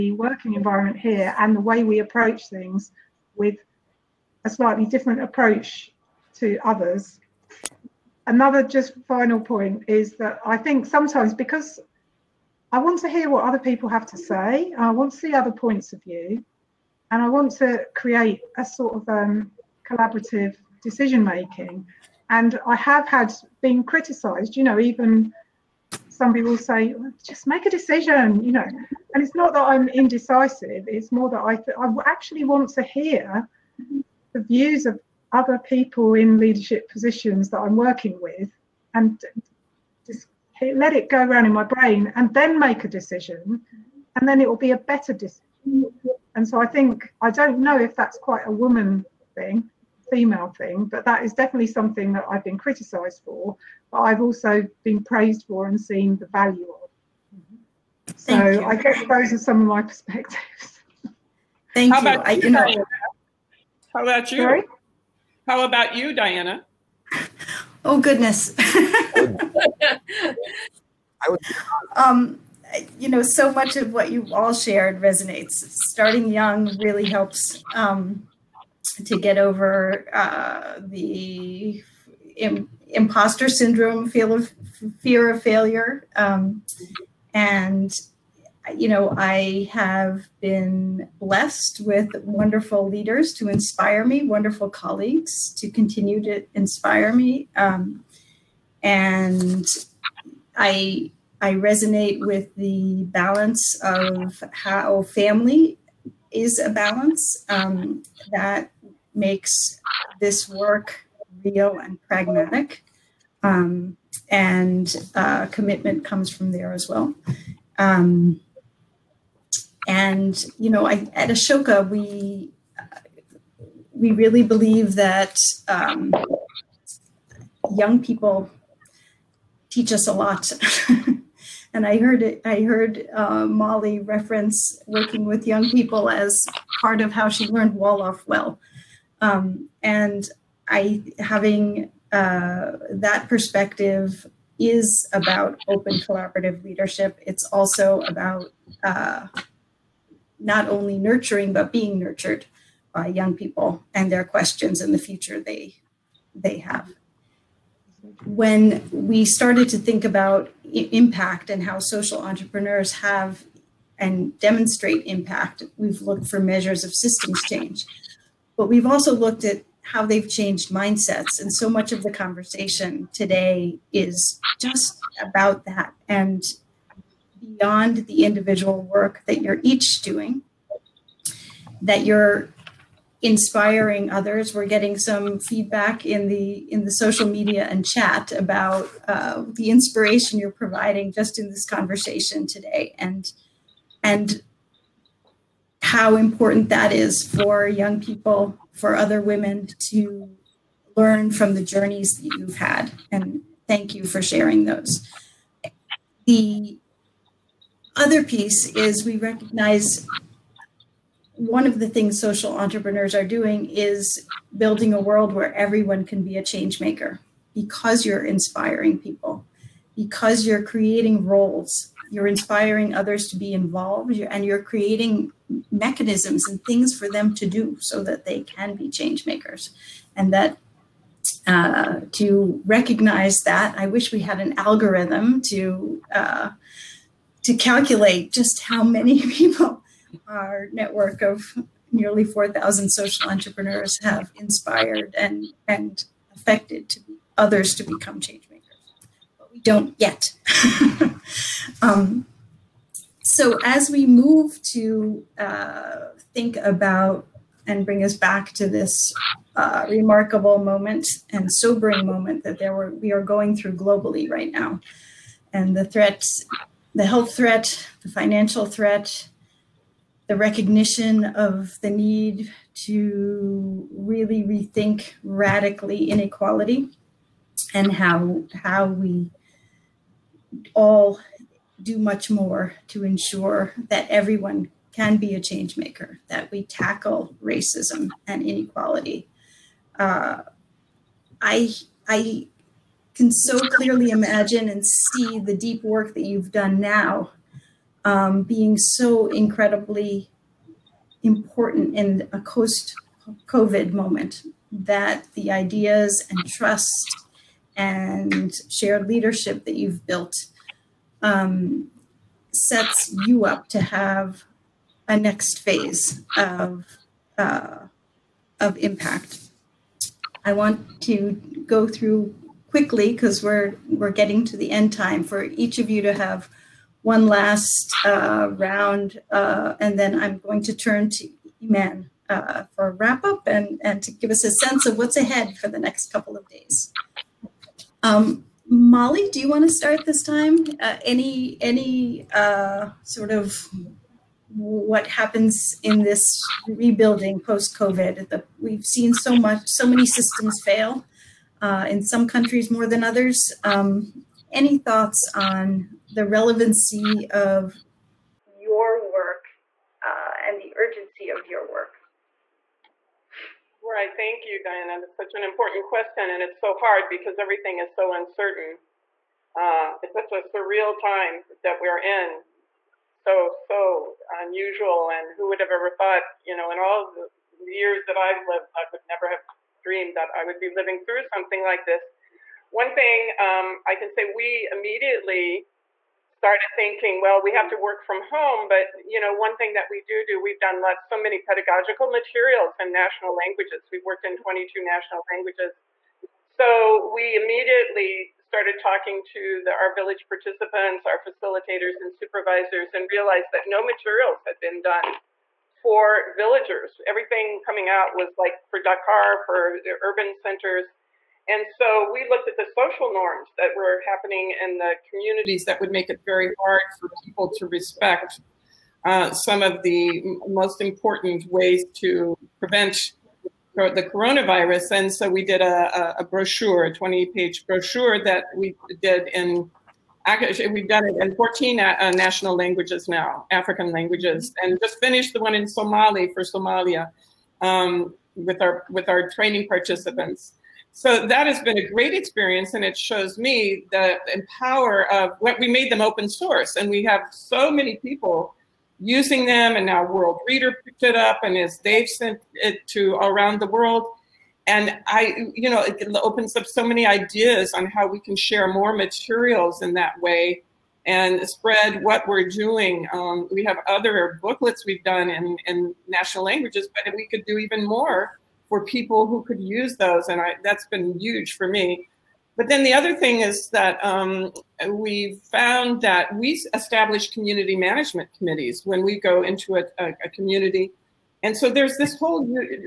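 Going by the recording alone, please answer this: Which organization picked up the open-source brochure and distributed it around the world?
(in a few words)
Worldreader.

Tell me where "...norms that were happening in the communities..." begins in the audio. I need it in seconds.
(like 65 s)
413 s.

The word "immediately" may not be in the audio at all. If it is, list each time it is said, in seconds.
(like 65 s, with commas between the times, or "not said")
384 s, 397 s.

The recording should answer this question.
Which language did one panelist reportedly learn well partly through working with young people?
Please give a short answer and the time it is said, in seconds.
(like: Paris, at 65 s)
Wolof, at 137 s.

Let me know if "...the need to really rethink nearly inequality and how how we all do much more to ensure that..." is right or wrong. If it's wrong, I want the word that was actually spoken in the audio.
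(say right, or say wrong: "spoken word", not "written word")
wrong: "radically", not "nearly".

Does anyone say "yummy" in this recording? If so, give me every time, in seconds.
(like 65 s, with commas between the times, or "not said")
not said.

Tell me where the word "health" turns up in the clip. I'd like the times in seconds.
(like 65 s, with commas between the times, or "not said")
267 s.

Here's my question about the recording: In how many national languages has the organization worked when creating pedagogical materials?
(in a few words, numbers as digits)
22.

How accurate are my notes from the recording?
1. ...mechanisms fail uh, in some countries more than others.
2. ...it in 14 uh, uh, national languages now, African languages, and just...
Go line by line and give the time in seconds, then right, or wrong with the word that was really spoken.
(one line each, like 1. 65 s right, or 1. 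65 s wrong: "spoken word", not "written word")
1. 350 s wrong: "systems", not "mechanisms"
2. 431 s right.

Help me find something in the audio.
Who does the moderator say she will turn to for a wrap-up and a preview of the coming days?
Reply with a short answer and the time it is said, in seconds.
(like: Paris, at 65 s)
Iman, at 331 s.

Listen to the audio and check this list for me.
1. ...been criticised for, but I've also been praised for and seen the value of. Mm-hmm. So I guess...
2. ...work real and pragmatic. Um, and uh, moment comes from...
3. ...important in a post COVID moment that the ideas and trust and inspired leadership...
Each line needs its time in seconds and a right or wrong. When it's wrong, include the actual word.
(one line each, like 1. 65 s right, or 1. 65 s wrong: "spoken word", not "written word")
1. 52 s right
2. 110 s wrong: "commitment", not "moment"
3. 301 s wrong: "shared", not "inspired".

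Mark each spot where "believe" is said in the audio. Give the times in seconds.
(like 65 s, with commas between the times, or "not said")
124 s.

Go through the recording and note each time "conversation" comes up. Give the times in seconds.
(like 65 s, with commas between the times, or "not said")
172 s, 191 s.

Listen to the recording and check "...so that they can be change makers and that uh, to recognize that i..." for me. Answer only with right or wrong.
right.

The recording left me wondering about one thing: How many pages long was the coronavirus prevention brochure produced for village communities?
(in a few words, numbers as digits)
20.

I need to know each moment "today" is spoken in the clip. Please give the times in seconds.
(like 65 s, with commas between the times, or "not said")
173 s, 192 s.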